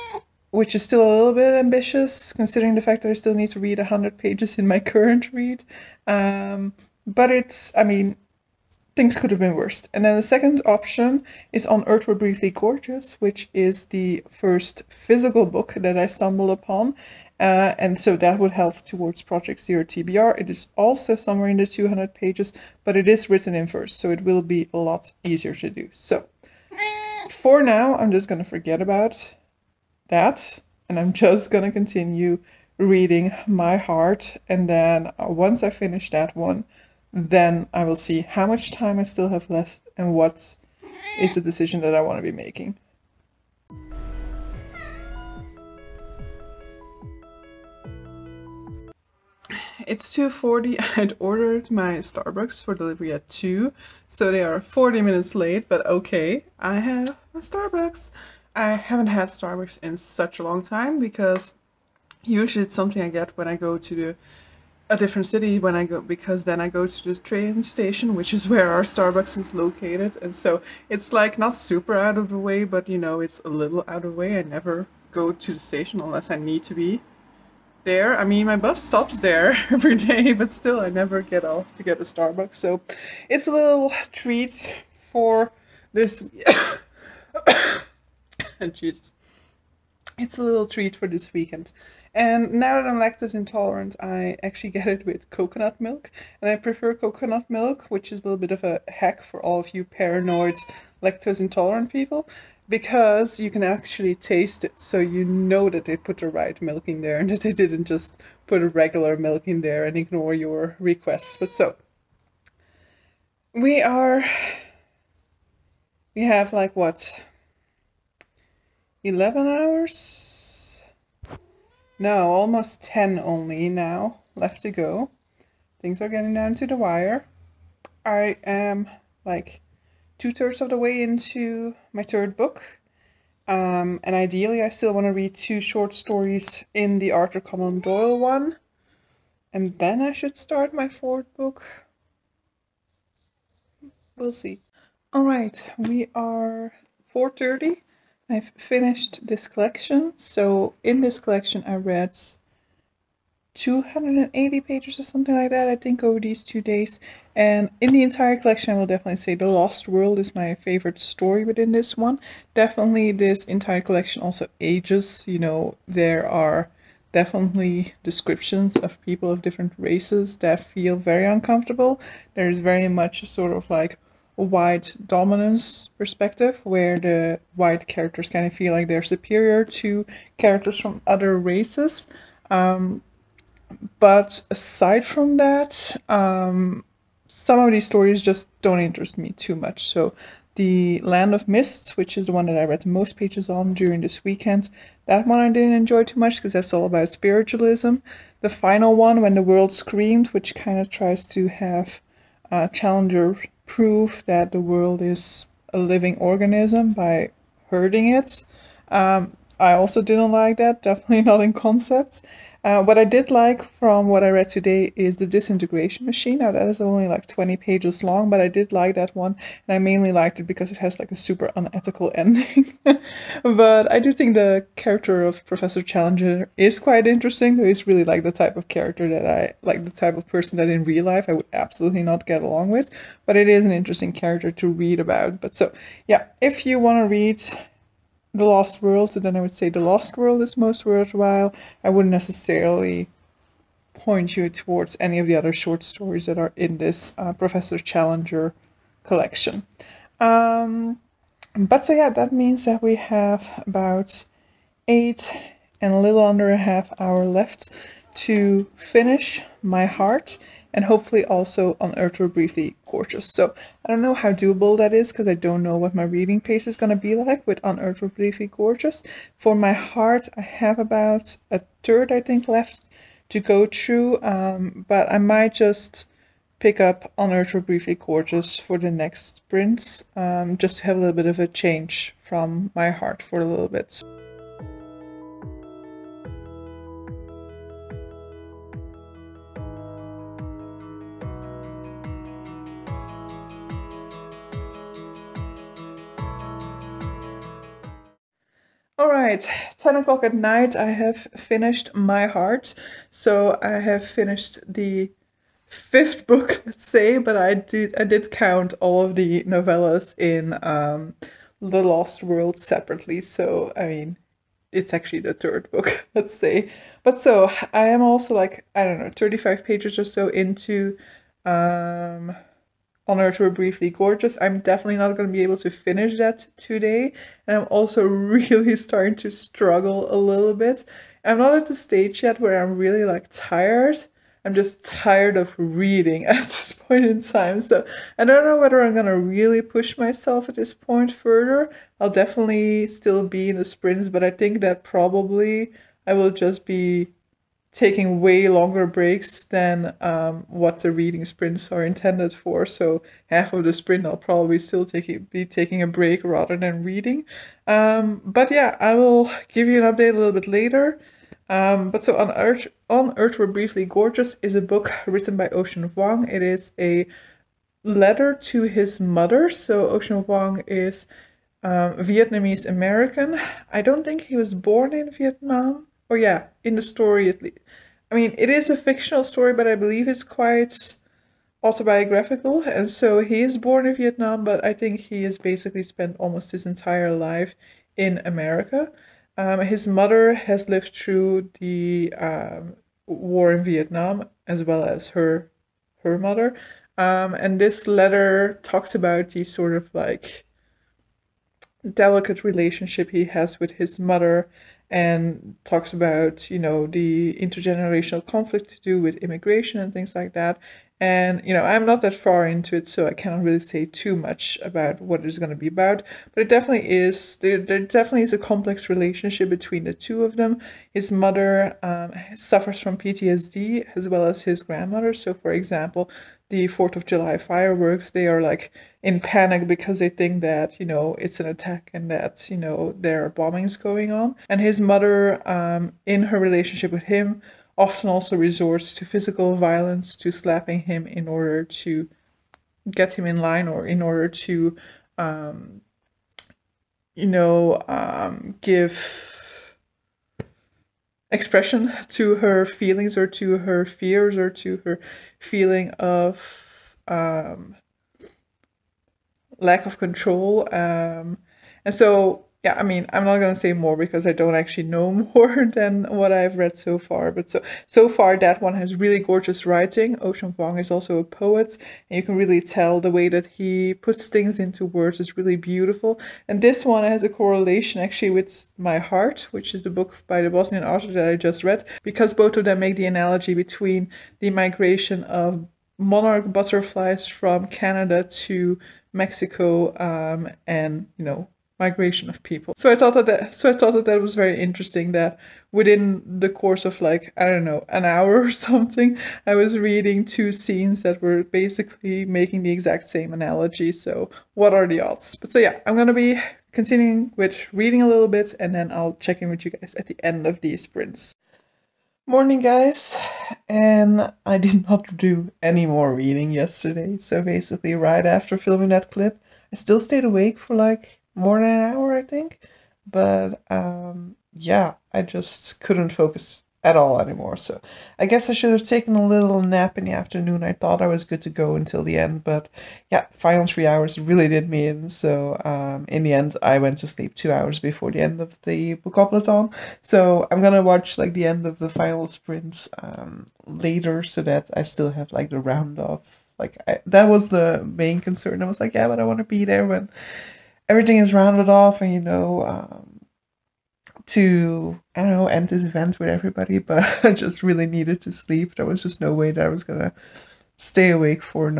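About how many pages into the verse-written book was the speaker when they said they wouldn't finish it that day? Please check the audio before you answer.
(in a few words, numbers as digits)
35.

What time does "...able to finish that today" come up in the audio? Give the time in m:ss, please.
5:25.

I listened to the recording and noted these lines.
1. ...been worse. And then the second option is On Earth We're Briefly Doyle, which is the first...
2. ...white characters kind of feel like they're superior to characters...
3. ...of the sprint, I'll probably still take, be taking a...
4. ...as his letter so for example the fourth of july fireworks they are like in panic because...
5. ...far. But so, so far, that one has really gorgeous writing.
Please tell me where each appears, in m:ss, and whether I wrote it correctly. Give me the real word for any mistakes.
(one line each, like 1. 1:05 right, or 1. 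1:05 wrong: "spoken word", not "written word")
1. 0:09 wrong: "Gorgeous", not "Doyle"
2. 2:57 right
3. 5:53 right
4. 7:04 wrong: "grandmother", not "letter"
5. 7:46 right.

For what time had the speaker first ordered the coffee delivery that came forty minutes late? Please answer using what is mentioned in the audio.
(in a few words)
2.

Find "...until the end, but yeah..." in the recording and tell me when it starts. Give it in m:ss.
8:51.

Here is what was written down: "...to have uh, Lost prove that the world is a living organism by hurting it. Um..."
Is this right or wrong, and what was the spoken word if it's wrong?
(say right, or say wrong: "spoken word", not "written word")
wrong: "Challenger", not "Lost".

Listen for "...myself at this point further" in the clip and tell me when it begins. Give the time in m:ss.
5:39.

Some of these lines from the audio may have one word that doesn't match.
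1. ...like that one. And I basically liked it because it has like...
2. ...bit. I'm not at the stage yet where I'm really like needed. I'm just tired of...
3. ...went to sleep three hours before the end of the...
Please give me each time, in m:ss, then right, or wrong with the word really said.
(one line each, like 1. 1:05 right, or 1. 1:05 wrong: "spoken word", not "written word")
1. 3:38 wrong: "mainly", not "basically"
2. 5:30 wrong: "tired", not "needed"
3. 8:56 wrong: "two", not "three".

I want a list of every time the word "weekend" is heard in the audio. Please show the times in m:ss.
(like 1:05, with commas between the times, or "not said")
1:31, 3:14.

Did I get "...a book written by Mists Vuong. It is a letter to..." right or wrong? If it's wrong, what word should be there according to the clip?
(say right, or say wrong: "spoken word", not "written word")
wrong: "Ocean", not "Mists".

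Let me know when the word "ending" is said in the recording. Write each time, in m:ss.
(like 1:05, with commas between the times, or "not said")
3:42.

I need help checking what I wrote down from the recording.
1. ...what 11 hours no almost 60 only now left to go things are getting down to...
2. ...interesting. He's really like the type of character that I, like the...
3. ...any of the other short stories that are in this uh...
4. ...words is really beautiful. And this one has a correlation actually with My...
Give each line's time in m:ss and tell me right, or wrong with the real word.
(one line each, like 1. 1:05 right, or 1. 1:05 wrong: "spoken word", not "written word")
1. 1:56 wrong: "10", not "60"
2. 3:47 right
3. 4:04 right
4. 7:54 right.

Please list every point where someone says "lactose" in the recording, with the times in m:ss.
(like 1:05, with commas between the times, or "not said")
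1:32, 1:41.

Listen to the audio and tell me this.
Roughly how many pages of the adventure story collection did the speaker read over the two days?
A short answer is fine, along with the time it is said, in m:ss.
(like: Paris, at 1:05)
280, at 2:33.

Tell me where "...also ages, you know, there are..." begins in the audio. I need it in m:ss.
2:44.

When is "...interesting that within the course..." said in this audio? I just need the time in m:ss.
8:14.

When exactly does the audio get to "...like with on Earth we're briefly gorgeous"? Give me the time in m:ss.
4:27.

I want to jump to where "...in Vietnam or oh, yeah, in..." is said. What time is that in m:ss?
6:14.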